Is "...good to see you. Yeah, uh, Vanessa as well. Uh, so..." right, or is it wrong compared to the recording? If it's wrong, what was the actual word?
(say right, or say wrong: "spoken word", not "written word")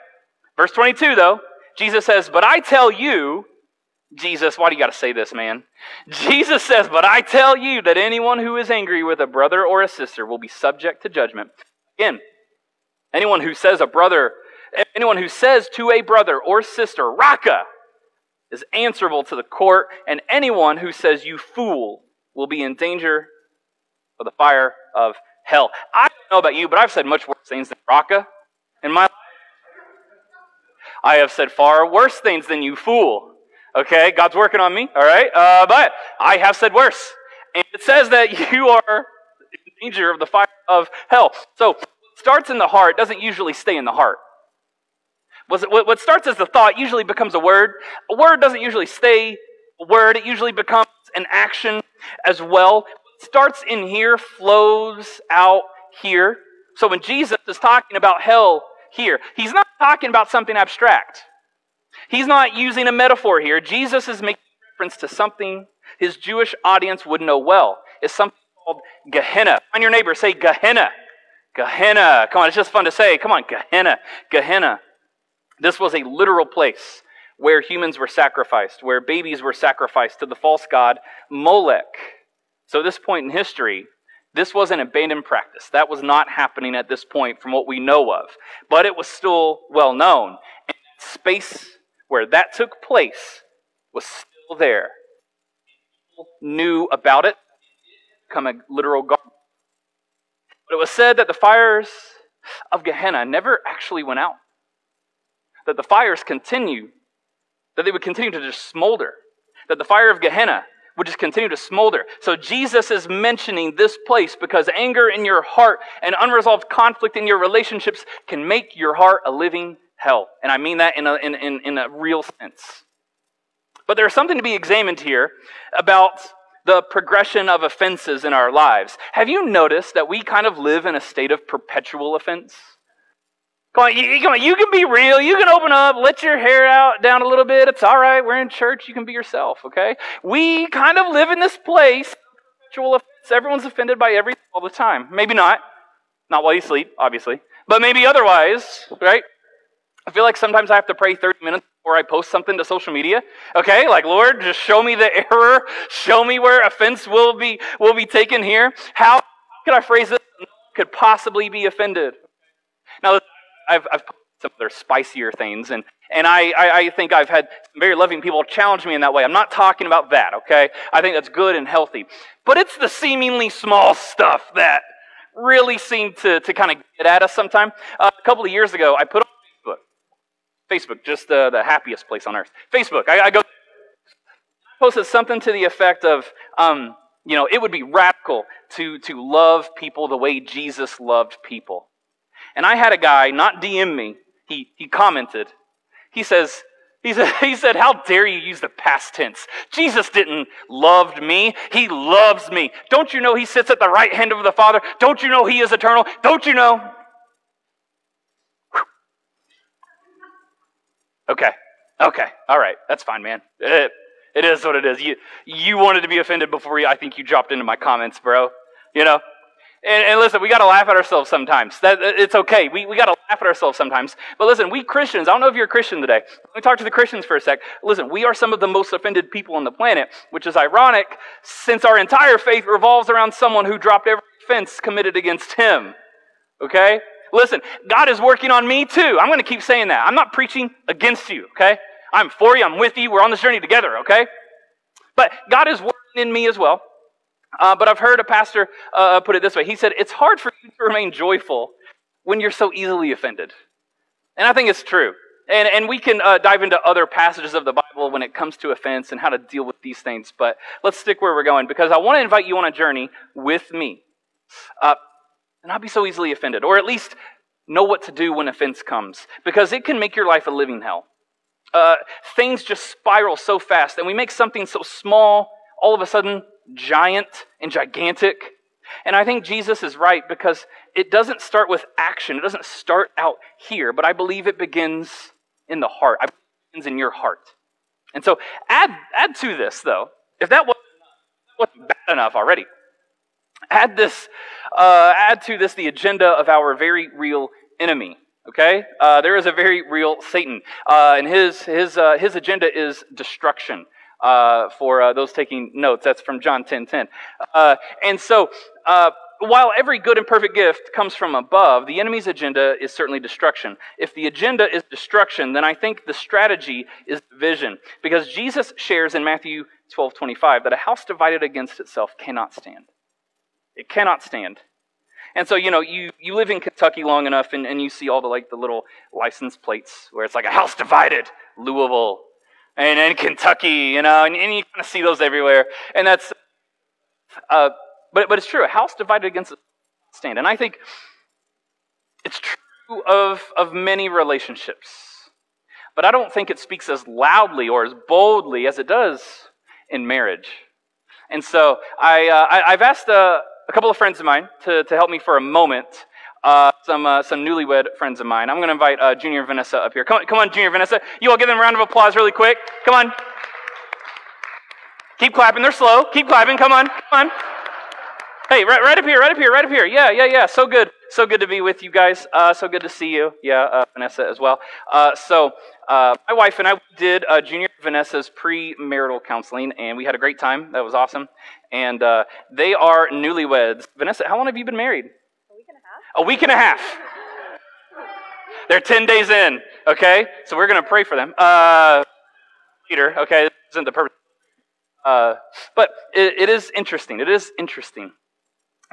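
right.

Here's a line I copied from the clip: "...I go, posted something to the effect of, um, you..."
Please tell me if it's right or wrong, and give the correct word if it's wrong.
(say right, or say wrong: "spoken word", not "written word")
right.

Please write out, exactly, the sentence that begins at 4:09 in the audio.
He said, It's hard for you to remain joyful when you're so easily offended.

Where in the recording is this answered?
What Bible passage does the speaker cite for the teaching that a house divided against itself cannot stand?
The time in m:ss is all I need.
5:19.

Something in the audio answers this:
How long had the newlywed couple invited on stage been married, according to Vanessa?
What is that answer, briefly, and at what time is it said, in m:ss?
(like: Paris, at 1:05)
A week and a half, at 6:26.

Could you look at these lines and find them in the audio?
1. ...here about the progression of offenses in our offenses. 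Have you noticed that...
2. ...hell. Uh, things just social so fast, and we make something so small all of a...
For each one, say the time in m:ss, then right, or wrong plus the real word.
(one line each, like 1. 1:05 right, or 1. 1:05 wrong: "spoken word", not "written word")
1. 2:05 wrong: "lives", not "offenses"
2. 4:30 wrong: "spiral", not "social".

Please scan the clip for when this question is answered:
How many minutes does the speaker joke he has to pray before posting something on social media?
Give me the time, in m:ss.
2:31.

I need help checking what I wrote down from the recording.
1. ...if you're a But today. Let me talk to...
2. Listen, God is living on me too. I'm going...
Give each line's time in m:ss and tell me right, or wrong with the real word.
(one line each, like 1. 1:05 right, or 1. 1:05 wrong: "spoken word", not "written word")
1. 3:45 wrong: "Christian", not "But"
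2. 3:57 wrong: "working", not "living".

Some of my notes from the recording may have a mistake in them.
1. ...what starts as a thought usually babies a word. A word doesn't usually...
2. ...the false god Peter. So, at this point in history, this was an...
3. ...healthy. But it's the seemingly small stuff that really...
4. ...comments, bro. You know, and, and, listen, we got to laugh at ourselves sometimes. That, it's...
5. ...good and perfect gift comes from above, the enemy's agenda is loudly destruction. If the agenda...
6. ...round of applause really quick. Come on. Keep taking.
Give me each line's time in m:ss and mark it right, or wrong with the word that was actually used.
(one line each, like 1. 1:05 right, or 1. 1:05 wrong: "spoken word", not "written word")
1. 0:45 wrong: "becomes", not "babies"
2. 1:20 wrong: "Molech", not "Peter"
3. 2:51 right
4. 3:37 right
5. 5:09 wrong: "certainly", not "loudly"
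6. 6:01 wrong: "clapping", not "taking".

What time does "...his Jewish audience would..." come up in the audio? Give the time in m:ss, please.
1:05.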